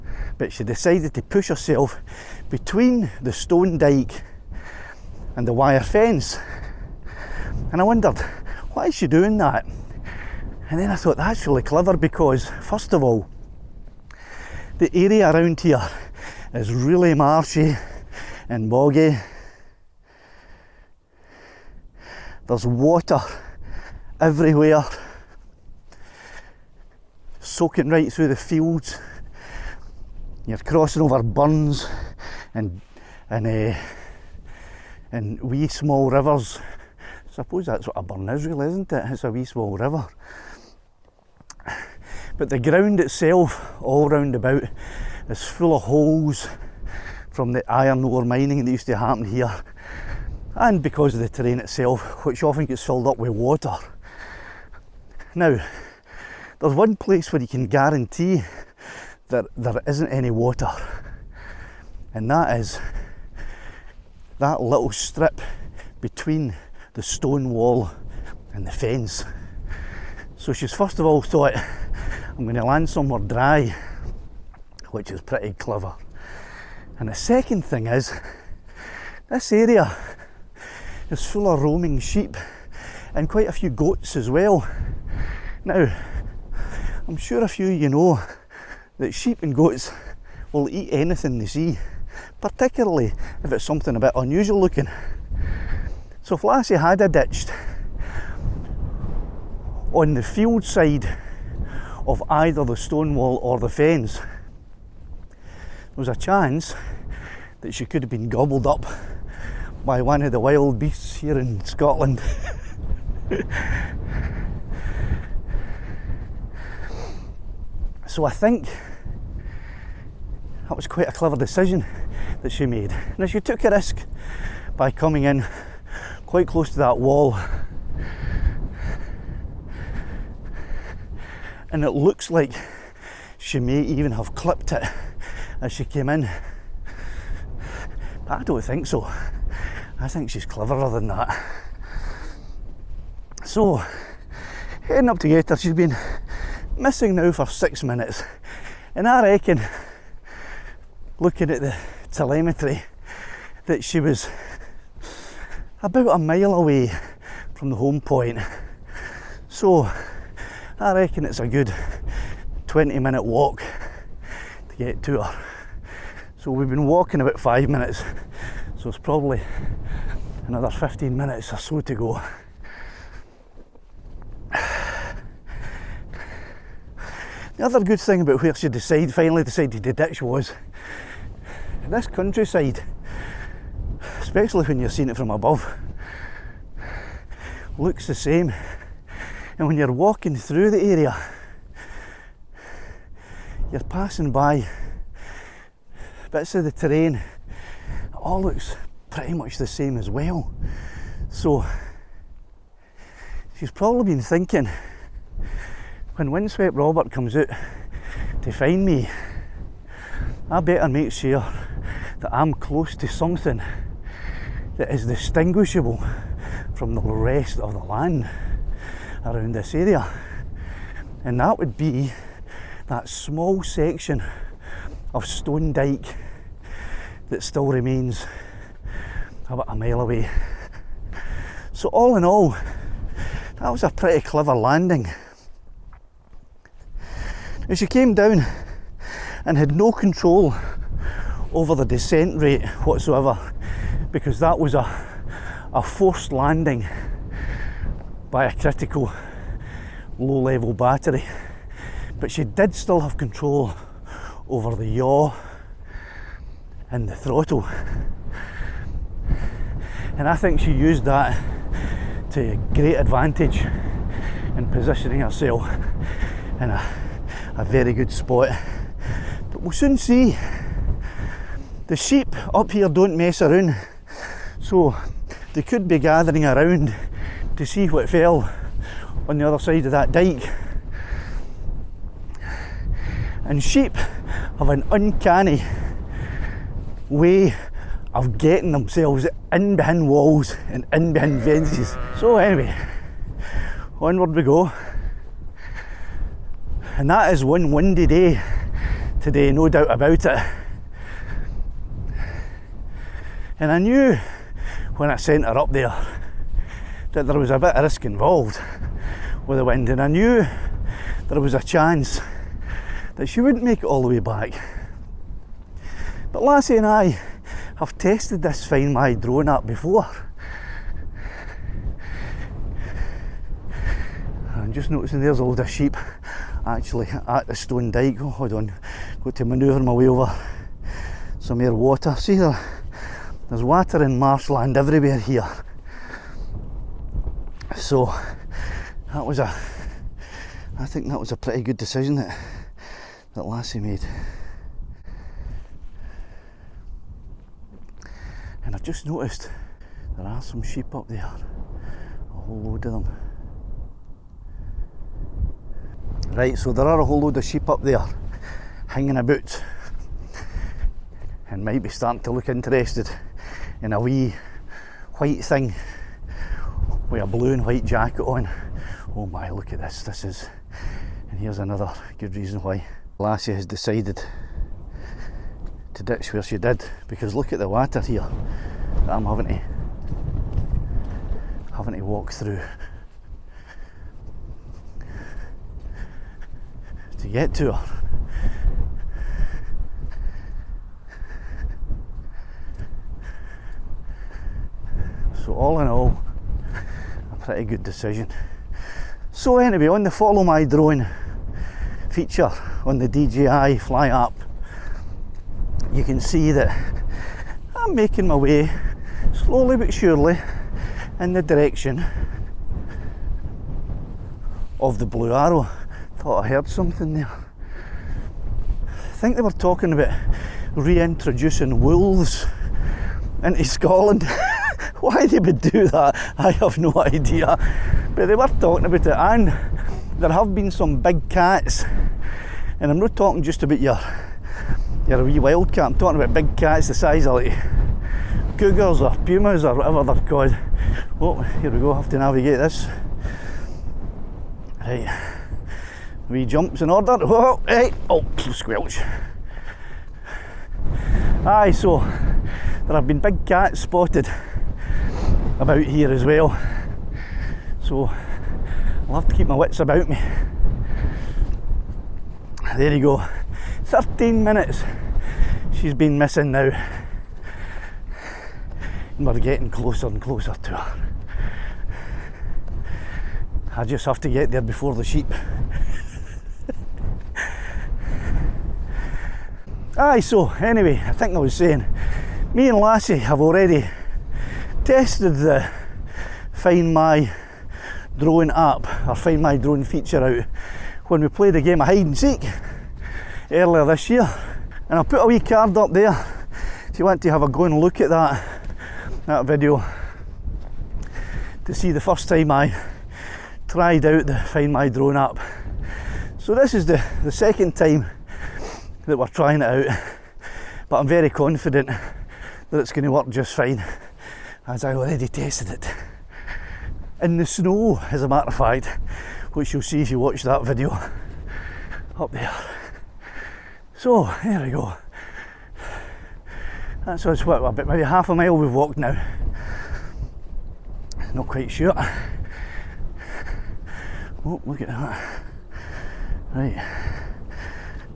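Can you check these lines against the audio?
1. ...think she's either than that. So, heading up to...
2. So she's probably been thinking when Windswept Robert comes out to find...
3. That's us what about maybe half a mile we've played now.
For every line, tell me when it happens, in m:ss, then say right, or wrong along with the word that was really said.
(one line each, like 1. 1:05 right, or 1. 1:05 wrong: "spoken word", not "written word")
1. 2:20 wrong: "cleverer", not "either"
2. 3:21 right
3. 8:47 wrong: "walked", not "played".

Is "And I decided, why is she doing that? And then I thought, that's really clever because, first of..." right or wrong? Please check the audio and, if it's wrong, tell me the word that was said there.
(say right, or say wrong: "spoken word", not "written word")
wrong: "wondered", not "decided".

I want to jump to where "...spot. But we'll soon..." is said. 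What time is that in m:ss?
4:28.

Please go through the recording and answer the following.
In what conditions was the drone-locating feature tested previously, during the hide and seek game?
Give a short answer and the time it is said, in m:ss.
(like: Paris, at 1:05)
In the snow, at 8:37.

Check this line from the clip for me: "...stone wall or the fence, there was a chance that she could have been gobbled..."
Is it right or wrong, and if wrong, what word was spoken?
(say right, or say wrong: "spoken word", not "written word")
right.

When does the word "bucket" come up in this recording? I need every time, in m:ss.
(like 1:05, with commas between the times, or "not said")
not said.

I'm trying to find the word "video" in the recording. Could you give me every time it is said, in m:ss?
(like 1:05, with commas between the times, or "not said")
8:19, 8:40.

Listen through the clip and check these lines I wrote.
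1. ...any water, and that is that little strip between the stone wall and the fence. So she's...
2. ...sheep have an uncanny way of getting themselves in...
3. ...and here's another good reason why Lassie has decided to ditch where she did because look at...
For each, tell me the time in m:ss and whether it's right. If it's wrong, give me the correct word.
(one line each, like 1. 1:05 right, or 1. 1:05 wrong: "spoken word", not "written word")
1. 1:00 right
2. 4:43 right
3. 6:11 right.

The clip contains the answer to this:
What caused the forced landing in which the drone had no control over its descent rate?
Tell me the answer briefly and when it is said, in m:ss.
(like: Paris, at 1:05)
critical low level battery, at 4:08.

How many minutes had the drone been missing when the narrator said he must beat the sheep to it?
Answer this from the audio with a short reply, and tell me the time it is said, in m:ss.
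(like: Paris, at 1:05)
13, at 7:43.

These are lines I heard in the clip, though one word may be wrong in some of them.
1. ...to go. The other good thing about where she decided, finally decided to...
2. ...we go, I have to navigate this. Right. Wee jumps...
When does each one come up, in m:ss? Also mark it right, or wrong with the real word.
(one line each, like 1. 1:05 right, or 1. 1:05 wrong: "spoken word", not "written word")
1. 2:51 right
2. 7:21 right.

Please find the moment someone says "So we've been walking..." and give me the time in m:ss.
2:46.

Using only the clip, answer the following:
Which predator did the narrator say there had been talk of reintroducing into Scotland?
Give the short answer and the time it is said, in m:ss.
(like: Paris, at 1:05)
wolves, at 7:01.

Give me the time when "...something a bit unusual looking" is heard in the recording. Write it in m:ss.
1:33.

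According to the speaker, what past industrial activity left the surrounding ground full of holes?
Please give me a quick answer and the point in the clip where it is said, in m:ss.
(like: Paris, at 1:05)
iron ore mining, at 0:47.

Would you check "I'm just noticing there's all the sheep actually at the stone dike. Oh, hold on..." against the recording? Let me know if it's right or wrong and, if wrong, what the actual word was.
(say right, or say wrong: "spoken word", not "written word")
right.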